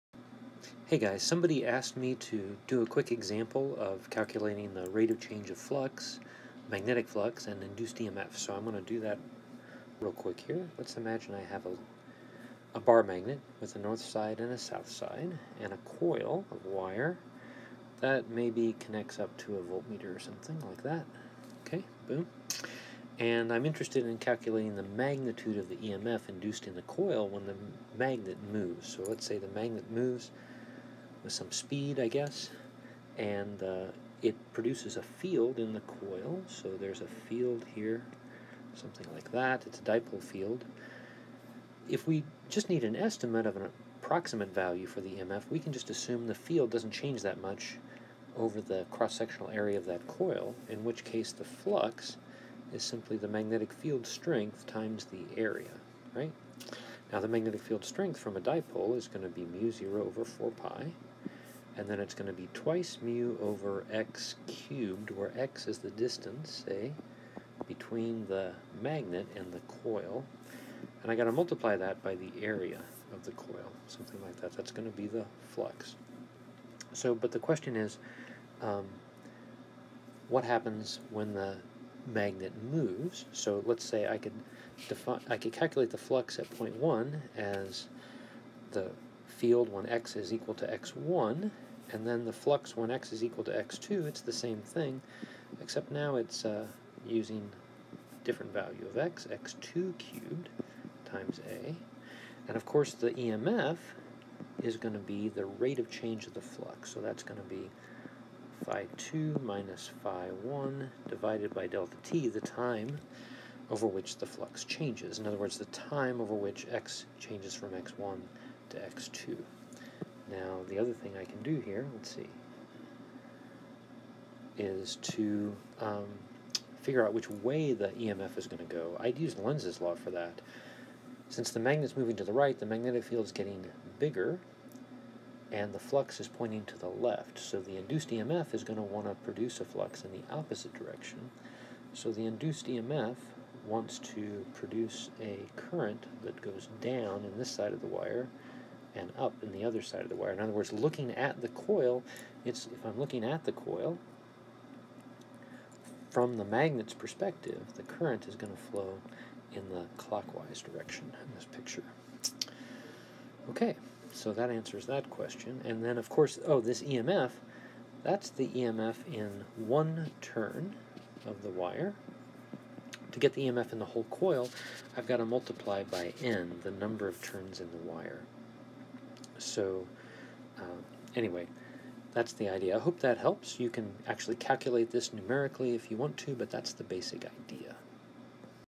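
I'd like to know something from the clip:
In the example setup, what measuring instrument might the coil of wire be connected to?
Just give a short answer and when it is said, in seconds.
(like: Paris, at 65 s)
voltmeter, at 19 s.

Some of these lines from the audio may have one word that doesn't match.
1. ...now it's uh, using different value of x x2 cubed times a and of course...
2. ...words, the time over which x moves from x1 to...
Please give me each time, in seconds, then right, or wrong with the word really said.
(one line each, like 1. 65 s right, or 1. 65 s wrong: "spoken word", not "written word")
1. 95 s right
2. 115 s wrong: "changes", not "moves".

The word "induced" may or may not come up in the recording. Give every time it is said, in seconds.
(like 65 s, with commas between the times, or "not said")
7 s, 26 s, 137 s, 142 s.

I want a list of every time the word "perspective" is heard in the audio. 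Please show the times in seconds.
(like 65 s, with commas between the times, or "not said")
156 s.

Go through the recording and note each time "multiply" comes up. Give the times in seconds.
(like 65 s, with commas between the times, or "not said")
71 s, 175 s.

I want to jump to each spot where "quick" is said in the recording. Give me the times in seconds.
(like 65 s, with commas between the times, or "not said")
2 s, 10 s.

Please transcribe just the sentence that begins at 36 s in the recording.
So there's a field here, something like that.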